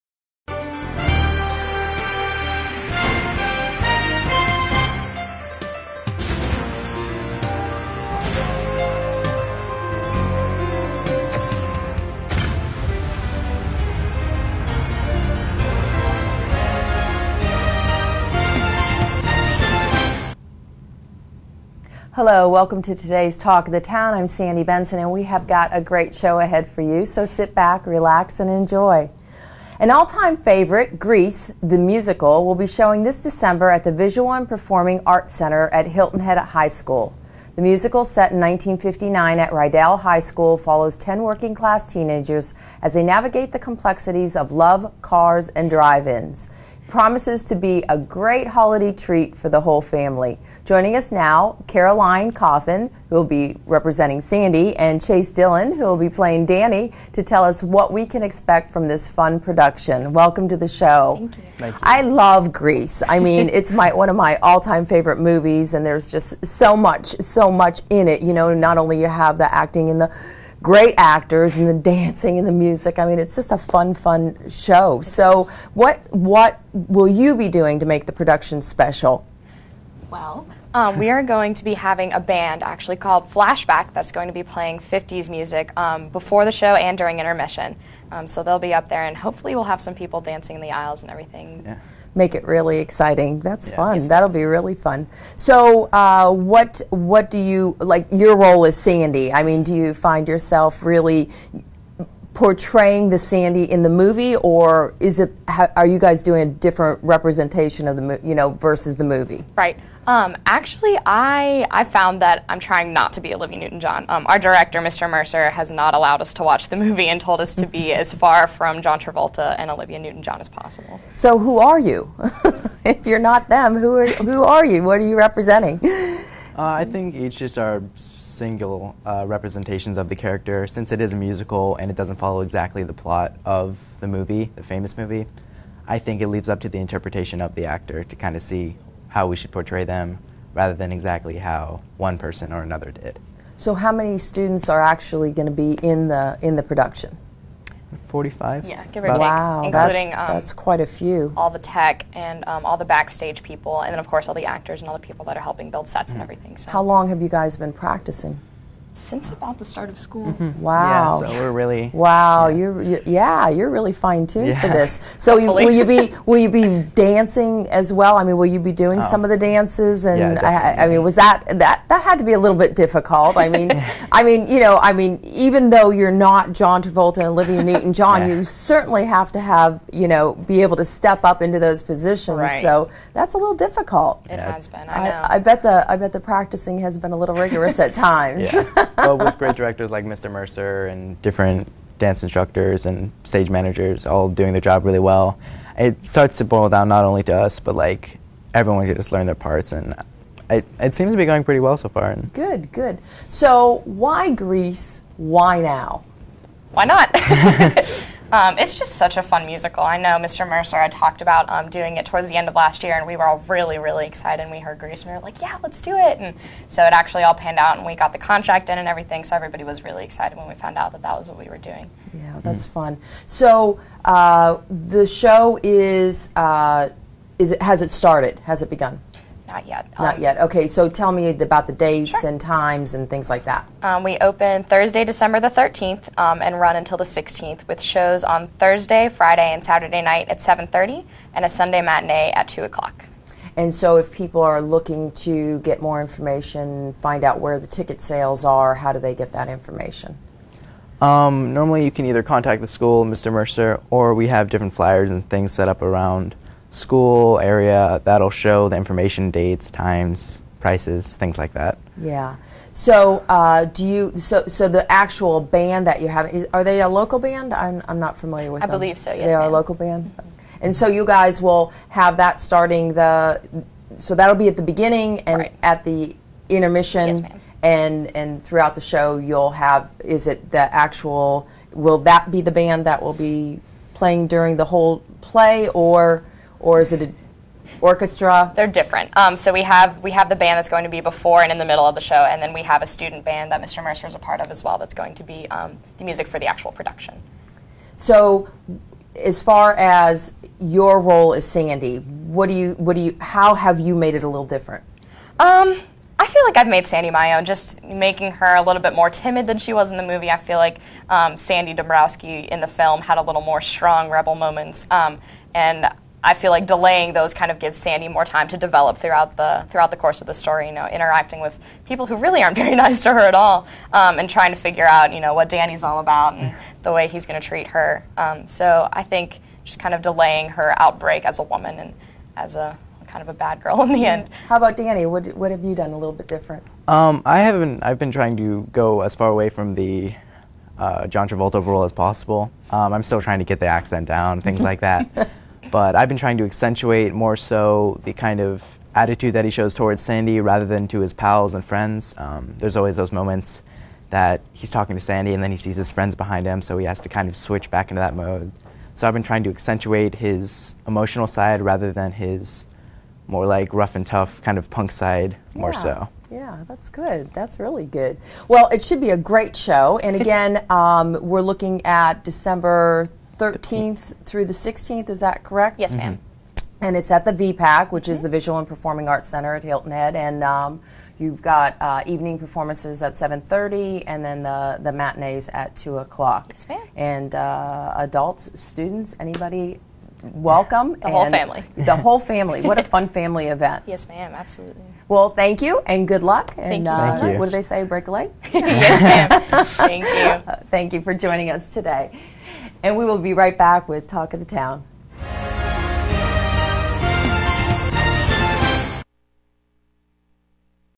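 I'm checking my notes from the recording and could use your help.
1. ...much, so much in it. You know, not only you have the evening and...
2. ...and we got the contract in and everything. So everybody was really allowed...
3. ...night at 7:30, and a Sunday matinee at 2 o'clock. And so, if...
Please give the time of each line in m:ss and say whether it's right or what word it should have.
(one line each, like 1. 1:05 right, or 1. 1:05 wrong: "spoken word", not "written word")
1. 1:06 wrong: "acting", not "evening"
2. 3:37 wrong: "excited", not "allowed"
3. 4:00 right.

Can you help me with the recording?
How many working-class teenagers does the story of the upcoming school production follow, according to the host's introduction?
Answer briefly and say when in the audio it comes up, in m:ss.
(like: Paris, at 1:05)
10, at 0:40.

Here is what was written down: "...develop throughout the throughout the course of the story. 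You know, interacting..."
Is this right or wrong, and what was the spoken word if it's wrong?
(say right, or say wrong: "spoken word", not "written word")
right.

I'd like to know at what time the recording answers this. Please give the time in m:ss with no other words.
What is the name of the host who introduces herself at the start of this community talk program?
0:24.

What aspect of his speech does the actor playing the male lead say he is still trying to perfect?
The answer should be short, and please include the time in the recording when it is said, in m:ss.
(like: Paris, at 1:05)
The accent, at 5:43.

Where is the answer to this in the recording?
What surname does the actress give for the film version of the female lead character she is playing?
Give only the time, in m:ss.
5:11.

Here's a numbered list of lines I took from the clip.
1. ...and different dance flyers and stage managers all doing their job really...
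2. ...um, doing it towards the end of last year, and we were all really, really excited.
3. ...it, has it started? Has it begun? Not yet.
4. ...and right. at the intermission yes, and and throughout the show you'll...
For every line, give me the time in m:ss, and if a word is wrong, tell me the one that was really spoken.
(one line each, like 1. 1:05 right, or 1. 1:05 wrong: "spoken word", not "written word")
1. 3:10 wrong: "instructors", not "flyers"
2. 3:31 right
3. 3:47 right
4. 4:35 right.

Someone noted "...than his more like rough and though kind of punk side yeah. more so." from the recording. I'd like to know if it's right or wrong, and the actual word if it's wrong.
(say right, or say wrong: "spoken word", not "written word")
wrong: "tough", not "though".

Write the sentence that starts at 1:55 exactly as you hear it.
Mercer, has not allowed us to watch the movie and told us to be mm-hmm.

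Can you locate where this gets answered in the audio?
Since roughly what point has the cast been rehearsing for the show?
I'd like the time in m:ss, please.
2:39.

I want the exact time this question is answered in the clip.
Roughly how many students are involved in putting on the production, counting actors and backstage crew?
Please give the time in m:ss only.
2:28.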